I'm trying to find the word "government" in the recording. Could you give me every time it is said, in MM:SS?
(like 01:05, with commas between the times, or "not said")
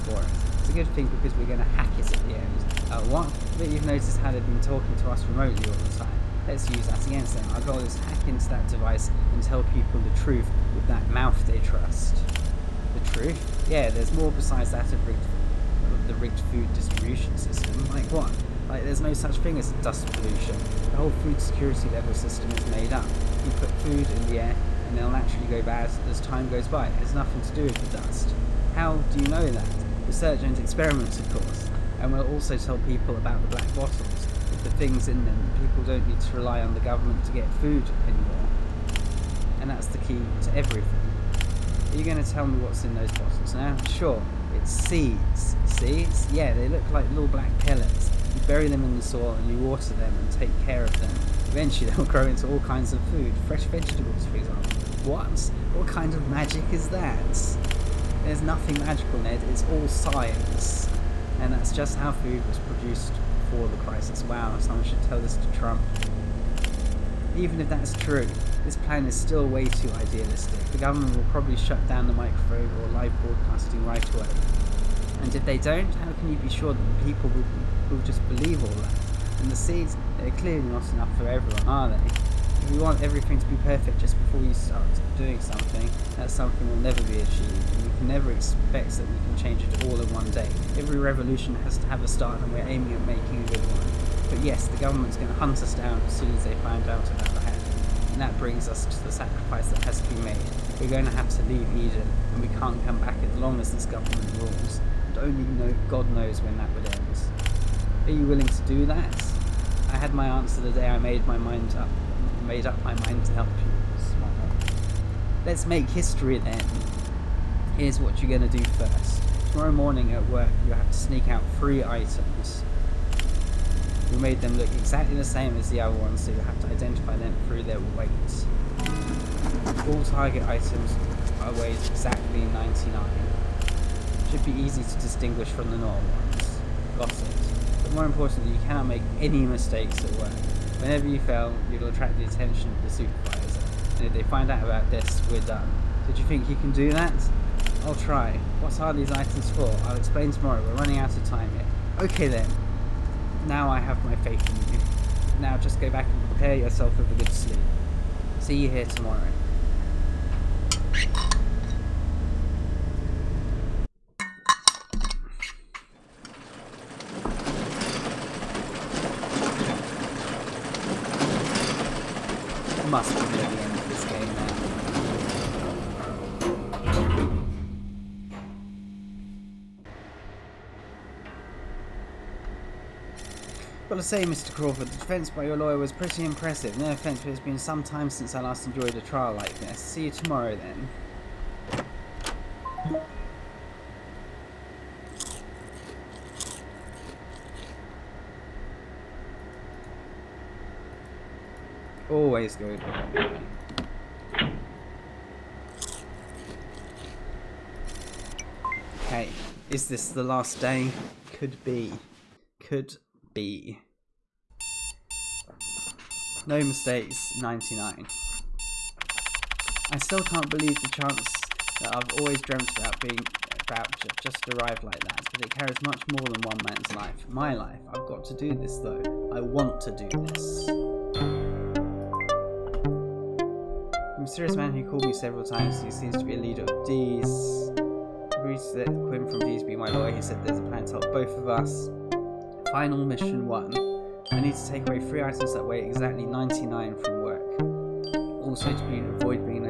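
00:36, 01:10, 01:34, 01:43.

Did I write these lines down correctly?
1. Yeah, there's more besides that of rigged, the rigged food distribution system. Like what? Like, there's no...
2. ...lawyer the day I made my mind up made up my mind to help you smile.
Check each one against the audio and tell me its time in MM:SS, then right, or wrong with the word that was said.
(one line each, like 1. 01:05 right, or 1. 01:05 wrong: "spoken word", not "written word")
1. 00:13 right
2. 01:50 wrong: "answer", not "lawyer".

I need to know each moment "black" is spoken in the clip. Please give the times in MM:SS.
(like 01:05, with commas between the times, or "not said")
00:33, 00:47.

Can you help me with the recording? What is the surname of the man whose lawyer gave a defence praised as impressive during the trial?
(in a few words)
Crawford.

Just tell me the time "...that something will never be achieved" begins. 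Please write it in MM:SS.
01:26.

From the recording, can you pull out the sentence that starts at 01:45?
And only God knows when that would end.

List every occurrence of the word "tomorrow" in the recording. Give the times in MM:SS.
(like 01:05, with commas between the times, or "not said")
01:59, 02:30, 02:38, 03:10.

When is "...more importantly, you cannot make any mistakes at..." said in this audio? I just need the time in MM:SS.
02:17.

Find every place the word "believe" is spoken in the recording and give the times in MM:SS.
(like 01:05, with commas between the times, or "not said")
01:18, 03:40.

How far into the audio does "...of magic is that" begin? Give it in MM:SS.
00:56.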